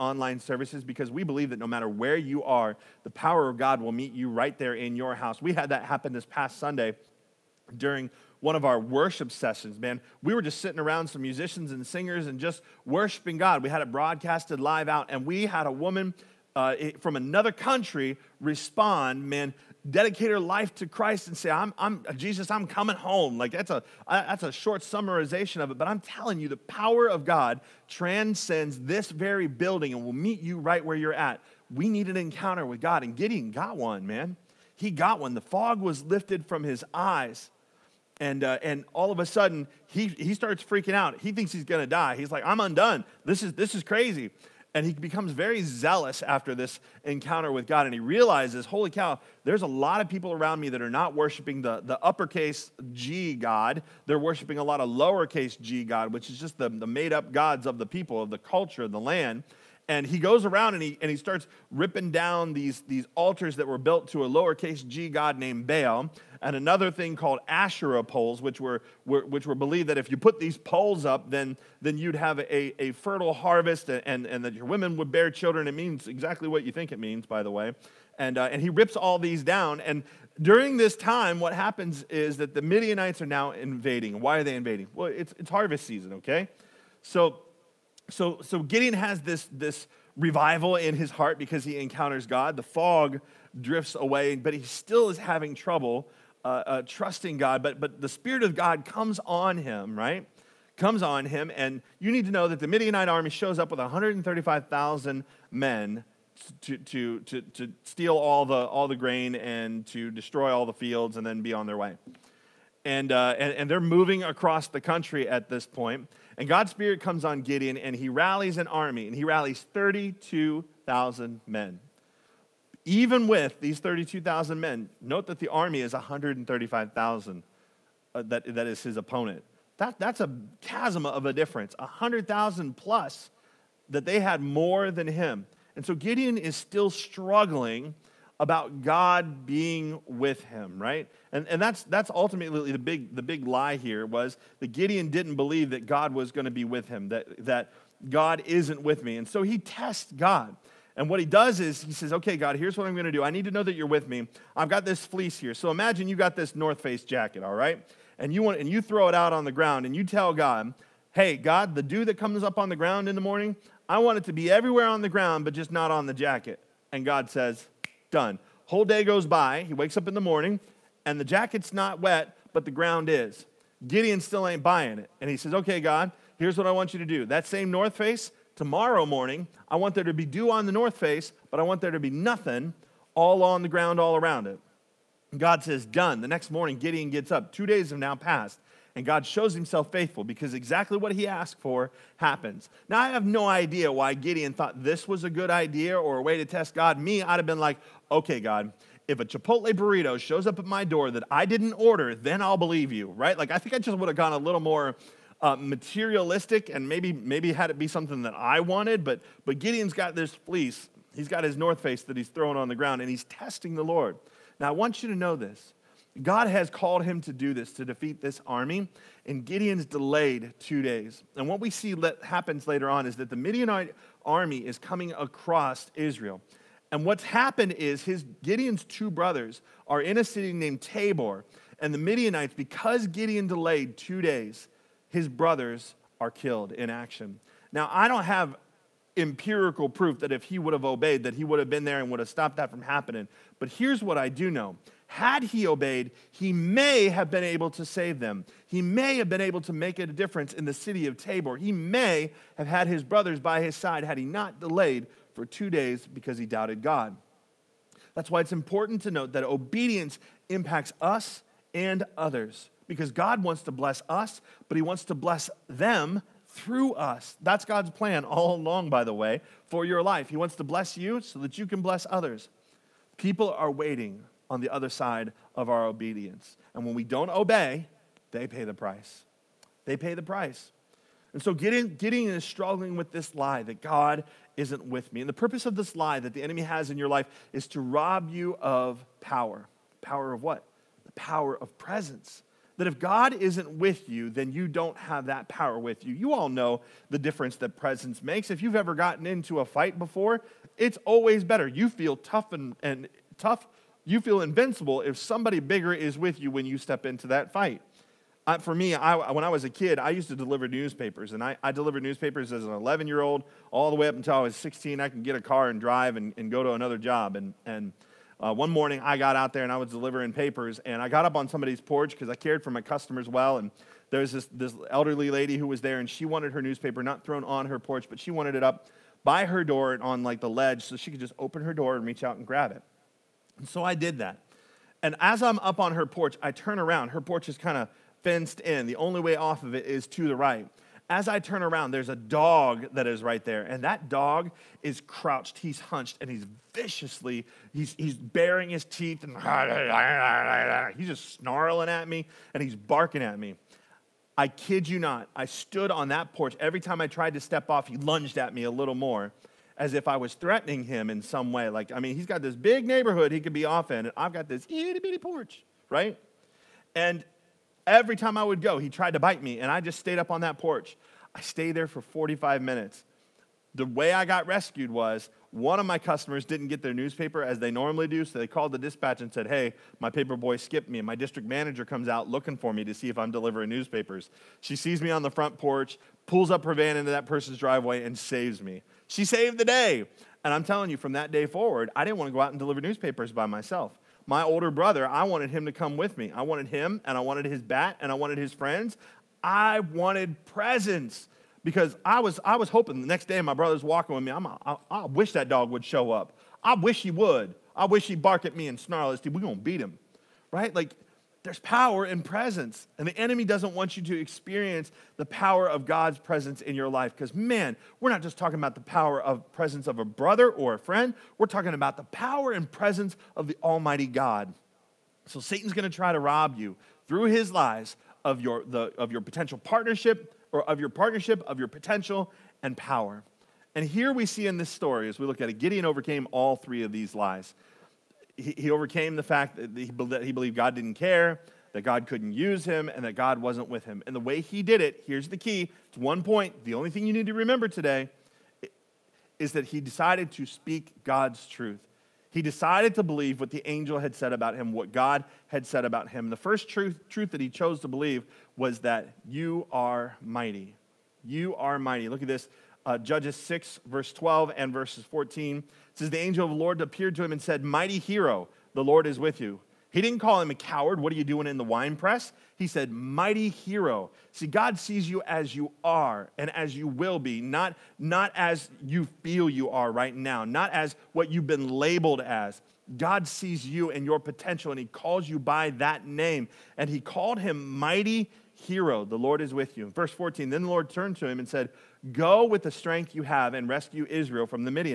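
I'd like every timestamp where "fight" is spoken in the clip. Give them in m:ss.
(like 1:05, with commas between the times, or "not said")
4:59, 5:07.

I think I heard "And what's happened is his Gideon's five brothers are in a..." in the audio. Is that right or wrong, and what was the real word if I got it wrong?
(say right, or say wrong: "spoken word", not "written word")
wrong: "two", not "five".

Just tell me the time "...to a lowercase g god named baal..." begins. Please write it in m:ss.
1:04.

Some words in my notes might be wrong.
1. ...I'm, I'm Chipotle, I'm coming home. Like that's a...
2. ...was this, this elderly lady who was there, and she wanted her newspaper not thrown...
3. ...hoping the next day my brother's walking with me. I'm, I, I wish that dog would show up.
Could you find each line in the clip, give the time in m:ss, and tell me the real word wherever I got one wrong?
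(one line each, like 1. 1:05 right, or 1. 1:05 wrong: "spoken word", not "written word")
1. 0:21 wrong: "Jesus", not "Chipotle"
2. 5:24 right
3. 6:42 right.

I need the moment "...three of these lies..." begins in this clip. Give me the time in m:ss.
7:16.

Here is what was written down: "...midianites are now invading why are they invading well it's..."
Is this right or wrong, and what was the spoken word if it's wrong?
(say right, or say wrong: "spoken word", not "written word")
right.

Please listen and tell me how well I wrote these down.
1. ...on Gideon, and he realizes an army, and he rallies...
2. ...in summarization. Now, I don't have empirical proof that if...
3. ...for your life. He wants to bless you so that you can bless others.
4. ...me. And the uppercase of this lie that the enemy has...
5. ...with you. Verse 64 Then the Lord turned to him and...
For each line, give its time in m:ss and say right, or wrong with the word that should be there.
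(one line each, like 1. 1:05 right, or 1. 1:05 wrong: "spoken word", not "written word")
1. 1:57 wrong: "rallies", not "realizes"
2. 3:56 wrong: "action", not "summarization"
3. 4:29 right
4. 4:45 wrong: "purpose", not "uppercase"
5. 8:09 wrong: "14", not "64".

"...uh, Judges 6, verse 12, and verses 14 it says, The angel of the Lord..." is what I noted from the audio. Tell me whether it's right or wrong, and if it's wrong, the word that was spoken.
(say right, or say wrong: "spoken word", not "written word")
right.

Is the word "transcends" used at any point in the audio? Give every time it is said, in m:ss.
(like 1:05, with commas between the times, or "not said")
0:27.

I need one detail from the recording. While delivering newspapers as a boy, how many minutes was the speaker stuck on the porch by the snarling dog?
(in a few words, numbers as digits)
45.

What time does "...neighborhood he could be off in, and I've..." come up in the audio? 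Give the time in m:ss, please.
6:02.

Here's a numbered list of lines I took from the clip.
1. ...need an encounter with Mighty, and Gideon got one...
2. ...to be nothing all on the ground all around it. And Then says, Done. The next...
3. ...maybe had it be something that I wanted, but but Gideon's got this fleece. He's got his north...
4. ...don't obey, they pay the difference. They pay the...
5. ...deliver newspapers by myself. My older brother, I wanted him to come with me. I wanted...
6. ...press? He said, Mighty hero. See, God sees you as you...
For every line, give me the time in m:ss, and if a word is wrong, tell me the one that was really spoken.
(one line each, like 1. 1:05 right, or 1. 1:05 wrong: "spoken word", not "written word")
1. 0:31 wrong: "God", not "Mighty"
2. 3:01 wrong: "God", not "Then"
3. 3:27 right
4. 4:37 wrong: "price", not "difference"
5. 6:32 right
6. 7:51 right.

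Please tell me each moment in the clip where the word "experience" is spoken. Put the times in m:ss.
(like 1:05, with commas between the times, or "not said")
6:54.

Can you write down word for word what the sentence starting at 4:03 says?
But here's what I do know had he obeyed, he may have been able to save them.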